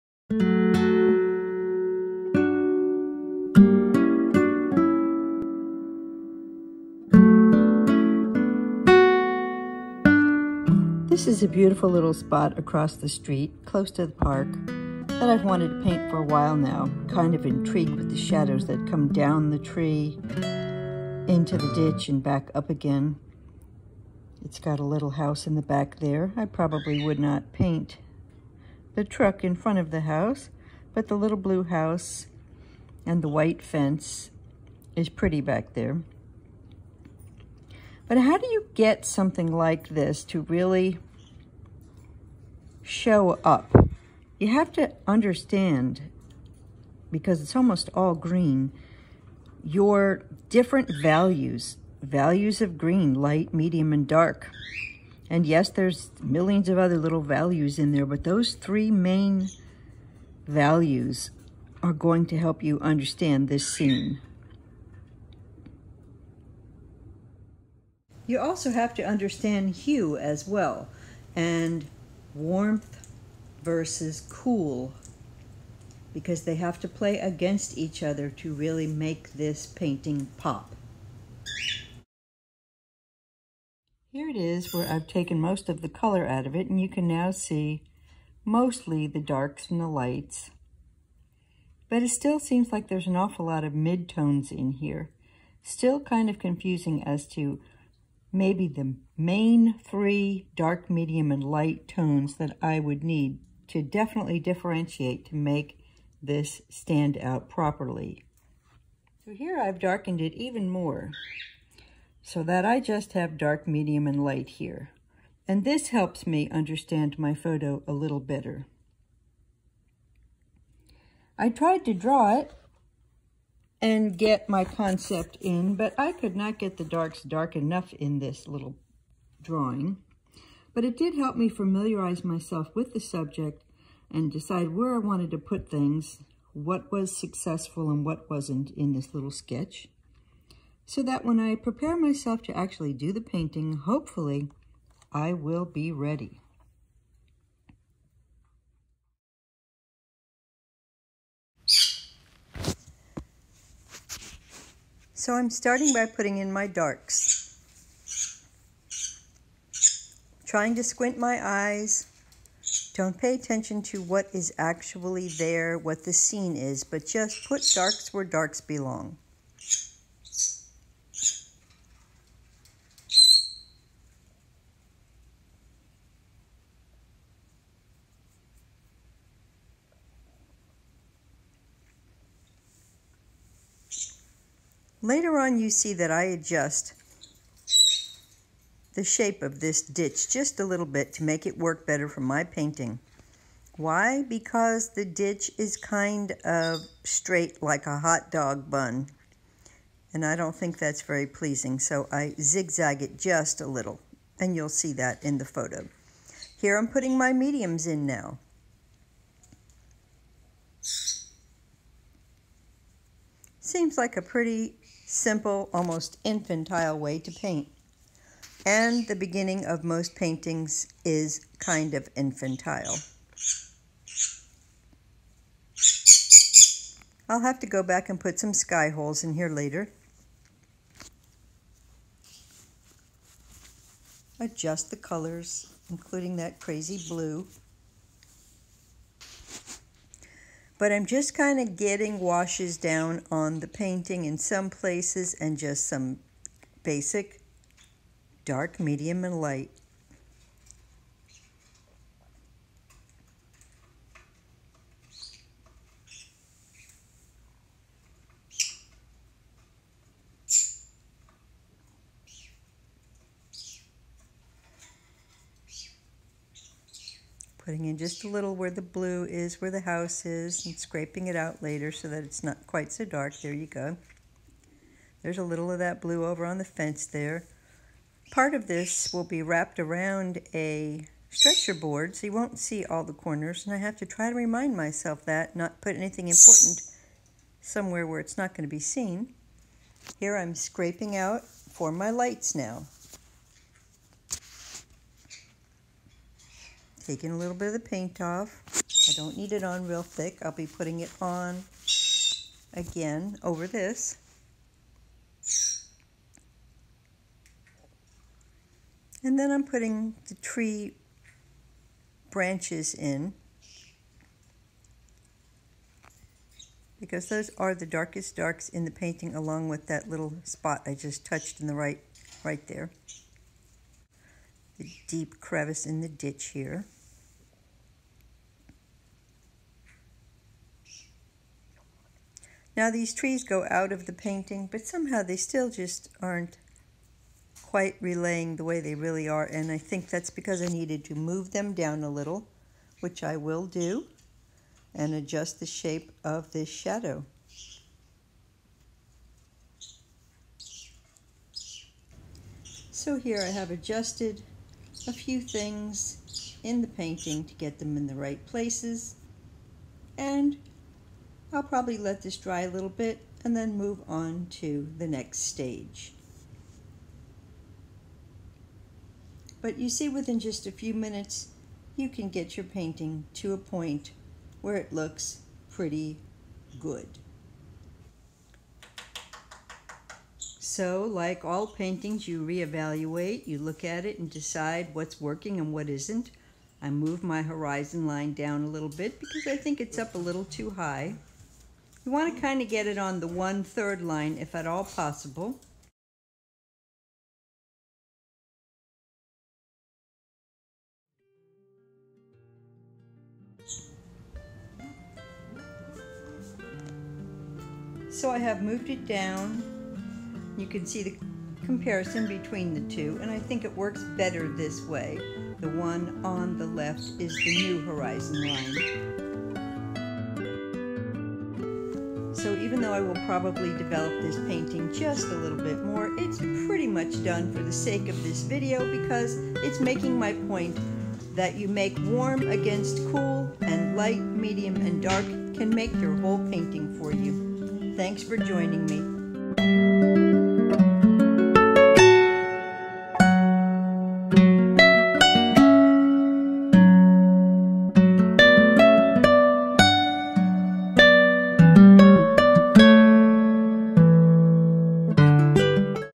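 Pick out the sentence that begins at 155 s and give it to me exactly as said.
So I'm starting by putting in my darks.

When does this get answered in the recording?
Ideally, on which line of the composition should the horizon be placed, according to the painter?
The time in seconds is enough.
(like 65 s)
393 s.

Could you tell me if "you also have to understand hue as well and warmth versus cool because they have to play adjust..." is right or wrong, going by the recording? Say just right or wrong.
wrong.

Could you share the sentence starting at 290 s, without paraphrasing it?
Here I'm scraping out for my lights now.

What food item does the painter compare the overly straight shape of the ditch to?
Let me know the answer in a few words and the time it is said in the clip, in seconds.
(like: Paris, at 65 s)
hot dog bun, at 197 s.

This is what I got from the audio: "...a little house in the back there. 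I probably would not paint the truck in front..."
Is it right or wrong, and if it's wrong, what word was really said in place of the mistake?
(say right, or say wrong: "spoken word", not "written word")
right.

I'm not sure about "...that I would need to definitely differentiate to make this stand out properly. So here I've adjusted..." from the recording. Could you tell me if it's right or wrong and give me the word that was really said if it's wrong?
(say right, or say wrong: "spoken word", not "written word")
wrong: "darkened", not "adjusted".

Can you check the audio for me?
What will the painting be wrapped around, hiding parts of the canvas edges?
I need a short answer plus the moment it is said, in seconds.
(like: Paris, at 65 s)
stretcher board, at 281 s.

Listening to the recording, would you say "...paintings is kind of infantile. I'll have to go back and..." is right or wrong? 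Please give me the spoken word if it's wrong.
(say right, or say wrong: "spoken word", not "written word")
right.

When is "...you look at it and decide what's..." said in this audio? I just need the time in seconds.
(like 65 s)
383 s.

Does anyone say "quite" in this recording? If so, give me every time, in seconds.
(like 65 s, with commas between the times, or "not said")
272 s, 337 s.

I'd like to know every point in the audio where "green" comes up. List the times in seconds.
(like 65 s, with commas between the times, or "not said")
48 s, 52 s.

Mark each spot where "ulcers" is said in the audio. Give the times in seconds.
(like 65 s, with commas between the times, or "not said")
not said.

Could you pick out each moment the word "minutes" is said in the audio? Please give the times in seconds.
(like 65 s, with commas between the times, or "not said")
370 s.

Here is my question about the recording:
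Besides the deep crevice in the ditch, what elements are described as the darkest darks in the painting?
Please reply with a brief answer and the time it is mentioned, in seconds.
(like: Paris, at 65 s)
tree branches, at 310 s.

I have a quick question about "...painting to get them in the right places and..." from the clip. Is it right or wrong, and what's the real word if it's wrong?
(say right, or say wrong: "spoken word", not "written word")
right.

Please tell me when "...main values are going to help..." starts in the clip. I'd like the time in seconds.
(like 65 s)
58 s.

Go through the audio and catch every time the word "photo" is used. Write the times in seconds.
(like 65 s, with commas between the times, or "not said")
117 s, 205 s.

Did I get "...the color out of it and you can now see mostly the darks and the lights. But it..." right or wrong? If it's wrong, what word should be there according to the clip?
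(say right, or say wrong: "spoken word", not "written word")
right.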